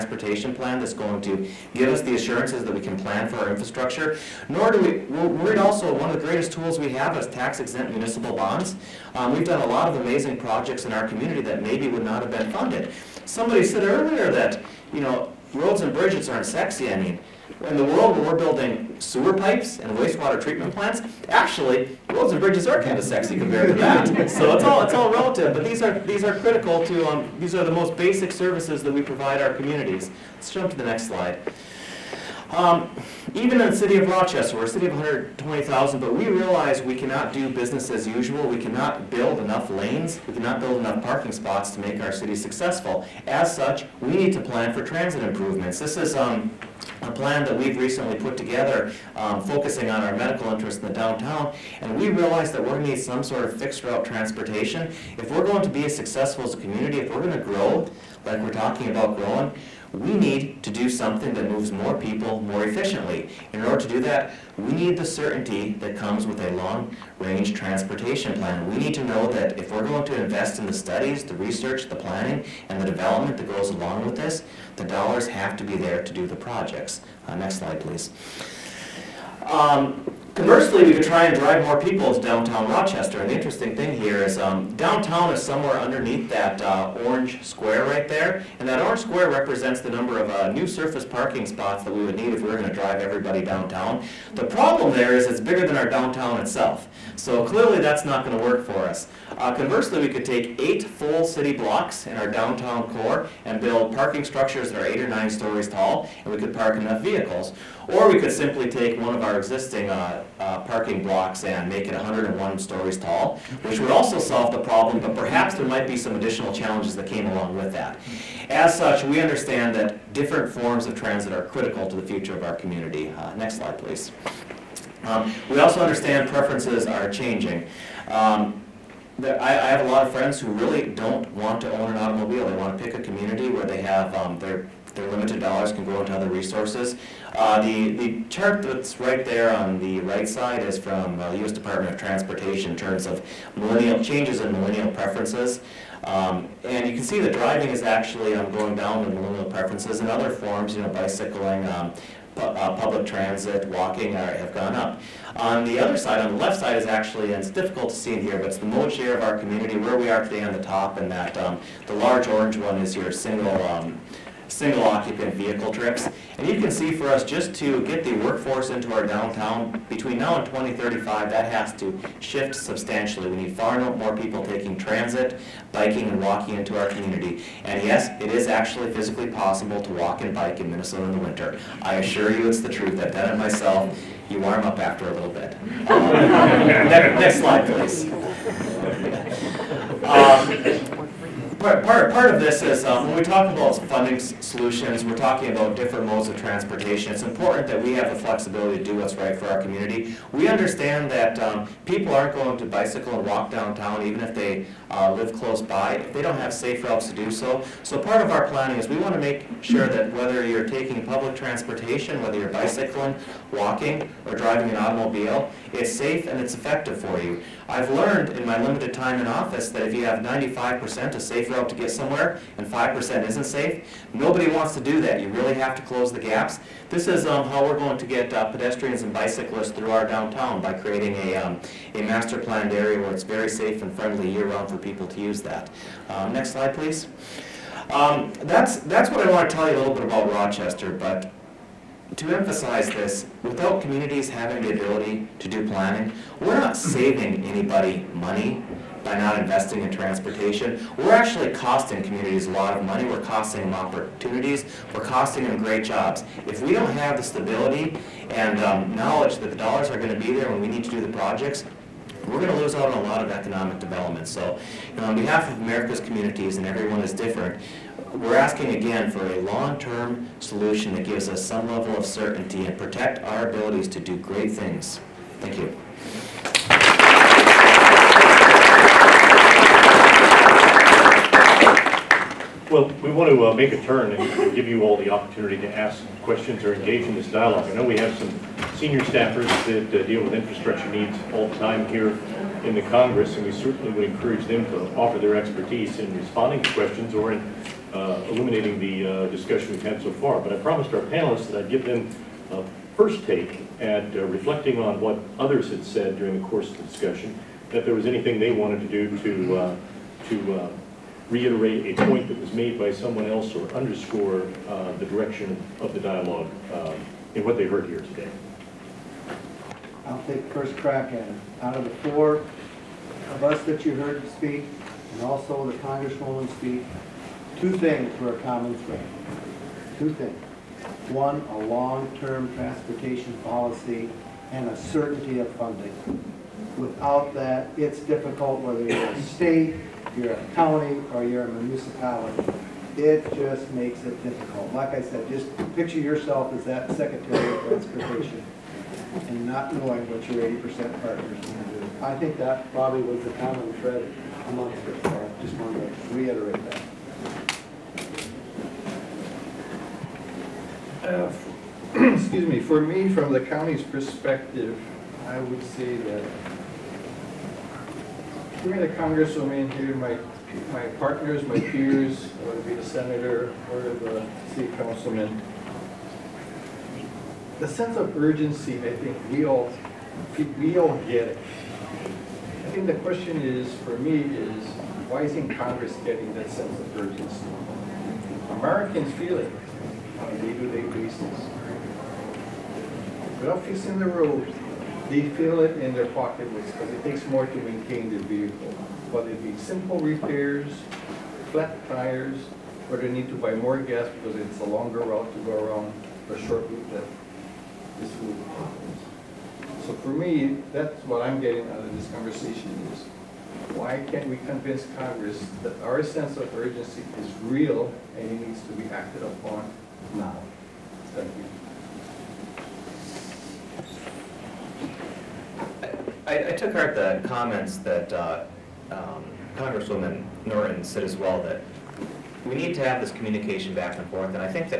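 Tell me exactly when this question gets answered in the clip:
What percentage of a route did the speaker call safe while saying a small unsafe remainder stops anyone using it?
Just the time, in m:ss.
3:40.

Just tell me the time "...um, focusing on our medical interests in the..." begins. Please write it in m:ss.
0:49.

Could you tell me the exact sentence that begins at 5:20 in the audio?
I'll take first crack at it.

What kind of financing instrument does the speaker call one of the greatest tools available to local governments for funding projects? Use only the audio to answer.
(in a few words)
tax-exempt municipal bonds.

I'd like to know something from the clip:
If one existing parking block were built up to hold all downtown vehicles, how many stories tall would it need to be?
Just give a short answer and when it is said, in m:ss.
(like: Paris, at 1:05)
101, at 1:51.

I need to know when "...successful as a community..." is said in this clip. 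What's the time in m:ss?
0:55.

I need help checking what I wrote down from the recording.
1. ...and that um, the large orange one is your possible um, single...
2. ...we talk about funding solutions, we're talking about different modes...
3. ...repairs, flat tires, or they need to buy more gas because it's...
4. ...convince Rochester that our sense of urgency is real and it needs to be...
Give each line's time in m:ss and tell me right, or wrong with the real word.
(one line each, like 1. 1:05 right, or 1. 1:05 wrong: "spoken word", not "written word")
1. 2:40 wrong: "single", not "possible"
2. 3:13 right
3. 6:39 right
4. 6:54 wrong: "Congress", not "Rochester".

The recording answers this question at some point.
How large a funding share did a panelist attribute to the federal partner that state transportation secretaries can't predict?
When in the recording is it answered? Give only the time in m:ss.
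5:50.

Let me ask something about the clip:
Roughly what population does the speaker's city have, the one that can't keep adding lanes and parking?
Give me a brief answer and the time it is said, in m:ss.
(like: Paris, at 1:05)
120,000, at 0:34.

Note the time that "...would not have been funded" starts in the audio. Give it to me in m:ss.
0:11.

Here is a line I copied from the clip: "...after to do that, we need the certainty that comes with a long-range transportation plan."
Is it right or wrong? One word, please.
wrong.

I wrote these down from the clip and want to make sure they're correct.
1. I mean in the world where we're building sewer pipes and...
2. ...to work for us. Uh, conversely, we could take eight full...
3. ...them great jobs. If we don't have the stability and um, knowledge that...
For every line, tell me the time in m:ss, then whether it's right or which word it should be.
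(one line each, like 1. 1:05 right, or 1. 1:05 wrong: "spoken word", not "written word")
1. 0:16 right
2. 1:38 right
3. 4:15 right.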